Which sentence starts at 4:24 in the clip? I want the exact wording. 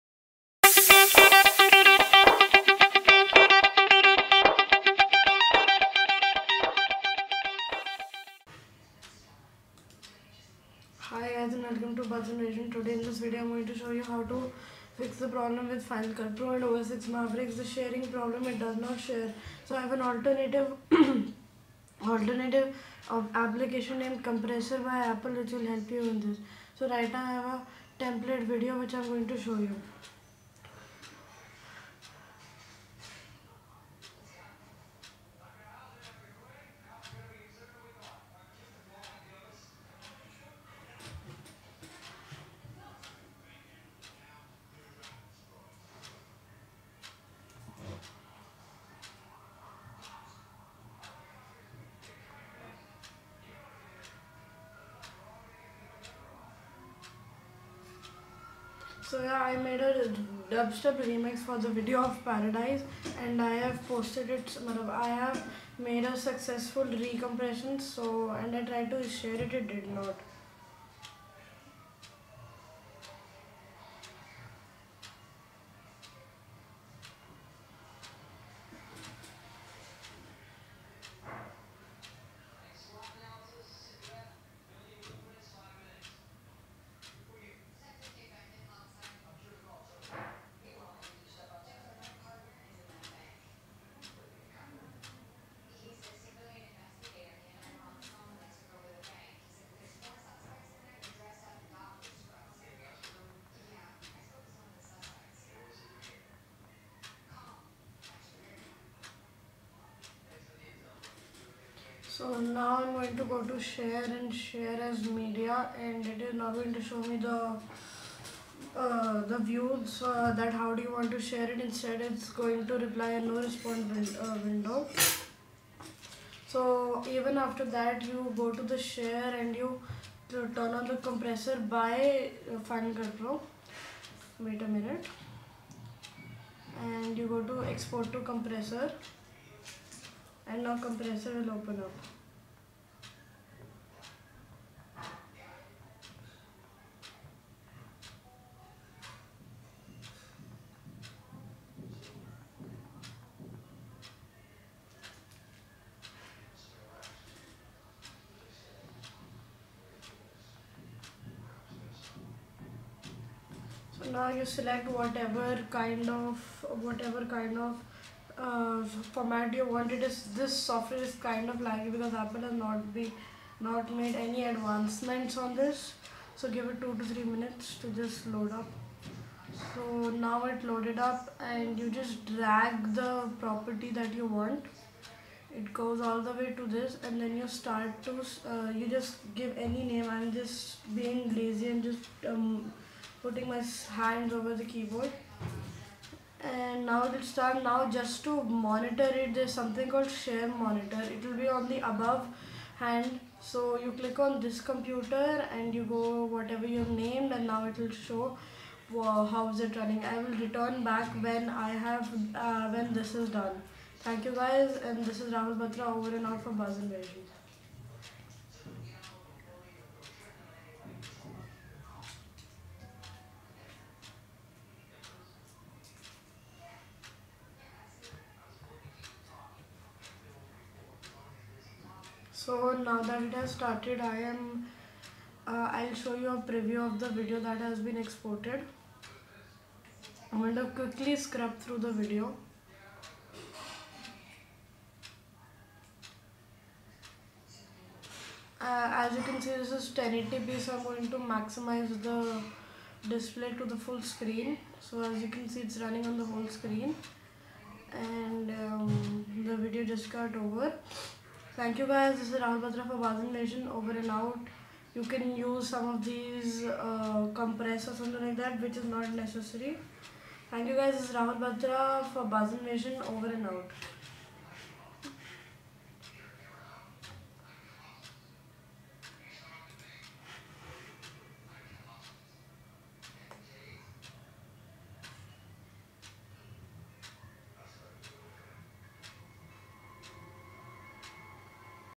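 You can use some of these uh, compress or something like that, which is not necessary.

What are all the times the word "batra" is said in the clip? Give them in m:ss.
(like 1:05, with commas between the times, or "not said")
3:35, 4:22, 4:31.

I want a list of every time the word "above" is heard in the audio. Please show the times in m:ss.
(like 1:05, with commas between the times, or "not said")
3:21.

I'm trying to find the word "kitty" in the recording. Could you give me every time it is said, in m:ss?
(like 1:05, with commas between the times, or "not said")
not said.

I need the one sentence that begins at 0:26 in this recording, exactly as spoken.
So right now I have a template video which I'm going to show you.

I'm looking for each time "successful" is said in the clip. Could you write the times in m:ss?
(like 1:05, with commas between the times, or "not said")
1:06.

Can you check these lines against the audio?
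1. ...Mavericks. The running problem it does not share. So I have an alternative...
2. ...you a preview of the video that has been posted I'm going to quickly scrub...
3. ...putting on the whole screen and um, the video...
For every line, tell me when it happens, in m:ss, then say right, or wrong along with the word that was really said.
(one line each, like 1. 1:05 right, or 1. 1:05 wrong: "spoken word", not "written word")
1. 0:17 wrong: "sharing", not "running"
2. 3:56 wrong: "exported", not "posted"
3. 4:15 wrong: "running", not "putting".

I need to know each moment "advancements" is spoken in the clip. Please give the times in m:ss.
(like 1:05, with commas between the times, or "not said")
2:54.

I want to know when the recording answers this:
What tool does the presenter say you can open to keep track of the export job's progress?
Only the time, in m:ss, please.
3:20.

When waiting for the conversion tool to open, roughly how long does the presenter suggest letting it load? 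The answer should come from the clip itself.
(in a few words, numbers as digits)
2 to 3 minutes.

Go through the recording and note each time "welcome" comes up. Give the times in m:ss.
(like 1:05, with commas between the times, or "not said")
0:11.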